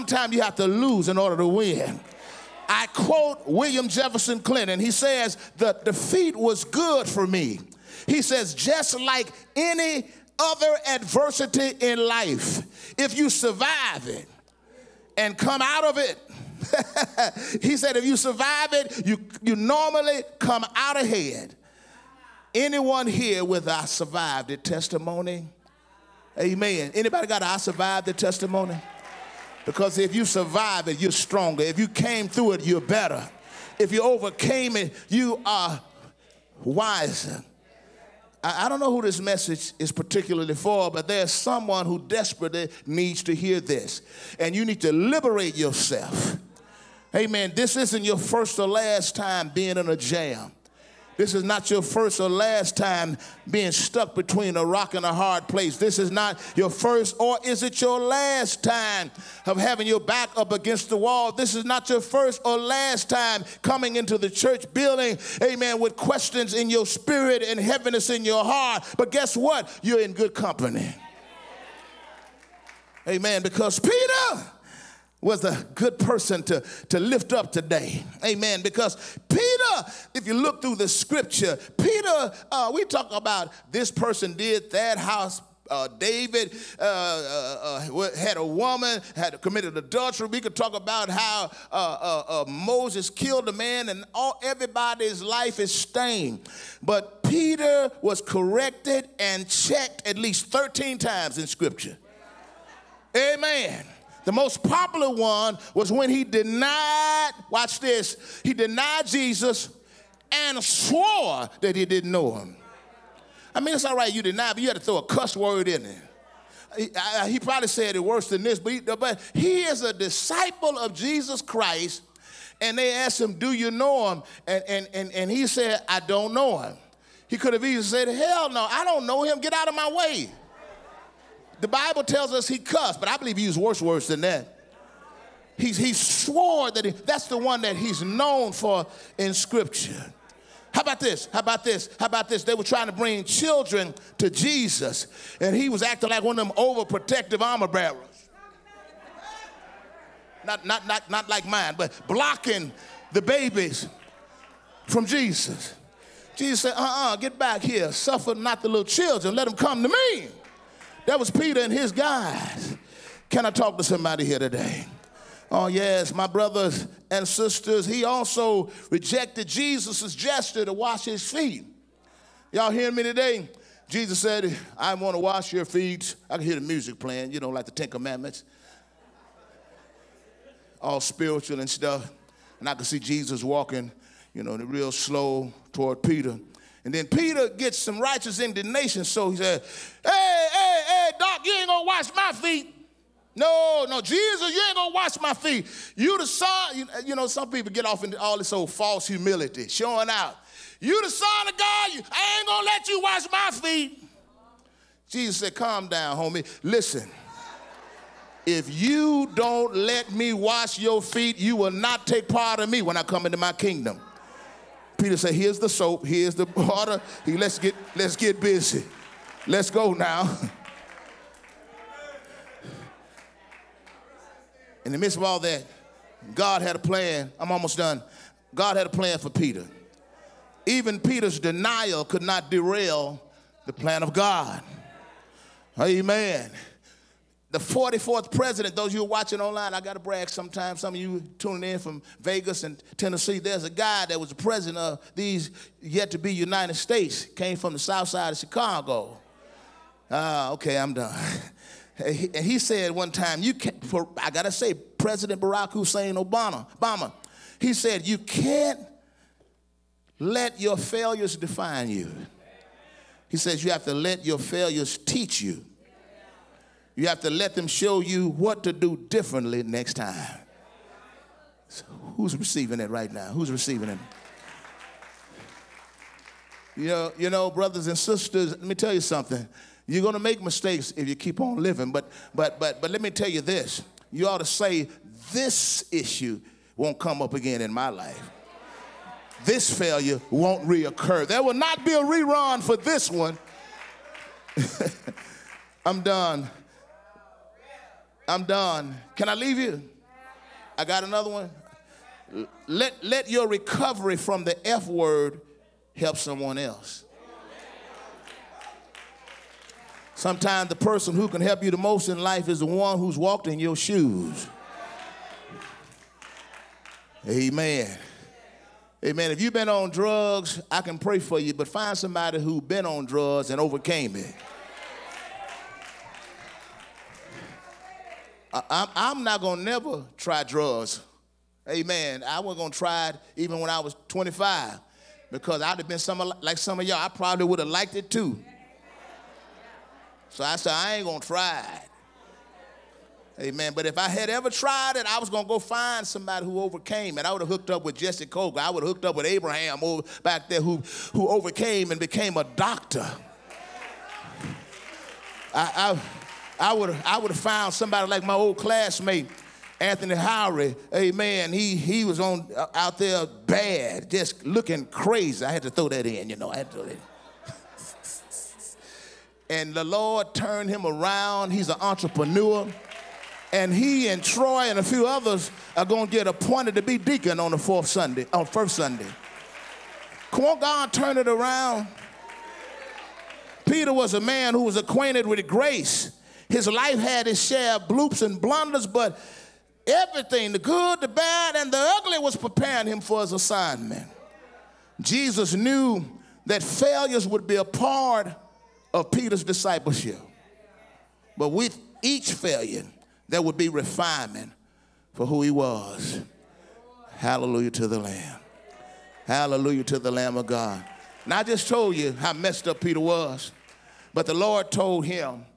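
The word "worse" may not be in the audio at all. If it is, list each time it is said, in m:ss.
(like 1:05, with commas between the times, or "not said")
1:58, 2:13.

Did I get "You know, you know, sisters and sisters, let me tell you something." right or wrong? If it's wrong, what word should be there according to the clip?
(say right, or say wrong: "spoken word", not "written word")
wrong: "brothers", not "sisters".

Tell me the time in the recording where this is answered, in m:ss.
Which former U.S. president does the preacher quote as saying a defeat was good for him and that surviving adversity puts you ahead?
0:03.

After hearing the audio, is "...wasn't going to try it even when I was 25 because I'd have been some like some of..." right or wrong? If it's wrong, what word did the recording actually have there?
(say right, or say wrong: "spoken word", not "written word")
right.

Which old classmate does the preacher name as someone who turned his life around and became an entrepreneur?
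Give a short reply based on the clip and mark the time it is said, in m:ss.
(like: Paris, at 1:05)
Anthony Howry, at 5:59.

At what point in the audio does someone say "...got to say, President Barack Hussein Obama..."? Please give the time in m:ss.
4:14.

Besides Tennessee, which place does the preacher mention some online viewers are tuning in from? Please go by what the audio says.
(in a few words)
Vegas.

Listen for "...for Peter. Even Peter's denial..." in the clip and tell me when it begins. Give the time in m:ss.
3:49.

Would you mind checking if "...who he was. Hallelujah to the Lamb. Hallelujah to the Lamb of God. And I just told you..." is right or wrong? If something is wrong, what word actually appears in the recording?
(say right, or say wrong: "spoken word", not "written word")
right.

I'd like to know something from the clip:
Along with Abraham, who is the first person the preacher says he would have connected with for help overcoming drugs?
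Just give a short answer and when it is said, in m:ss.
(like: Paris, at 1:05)
Jesse Coker, at 5:47.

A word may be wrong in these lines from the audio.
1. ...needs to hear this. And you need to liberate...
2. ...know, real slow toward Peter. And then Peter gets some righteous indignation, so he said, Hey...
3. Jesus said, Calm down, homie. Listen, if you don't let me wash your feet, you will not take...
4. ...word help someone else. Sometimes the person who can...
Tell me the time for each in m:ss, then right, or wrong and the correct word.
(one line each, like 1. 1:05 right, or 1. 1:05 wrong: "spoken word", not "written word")
1. 0:42 right
2. 3:04 right
3. 3:25 right
4. 5:04 right.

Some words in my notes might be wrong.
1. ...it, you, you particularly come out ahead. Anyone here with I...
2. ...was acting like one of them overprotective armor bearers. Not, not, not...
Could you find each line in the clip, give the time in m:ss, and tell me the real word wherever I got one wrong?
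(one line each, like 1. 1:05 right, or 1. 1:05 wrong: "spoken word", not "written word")
1. 0:18 wrong: "normally", not "particularly"
2. 2:25 right.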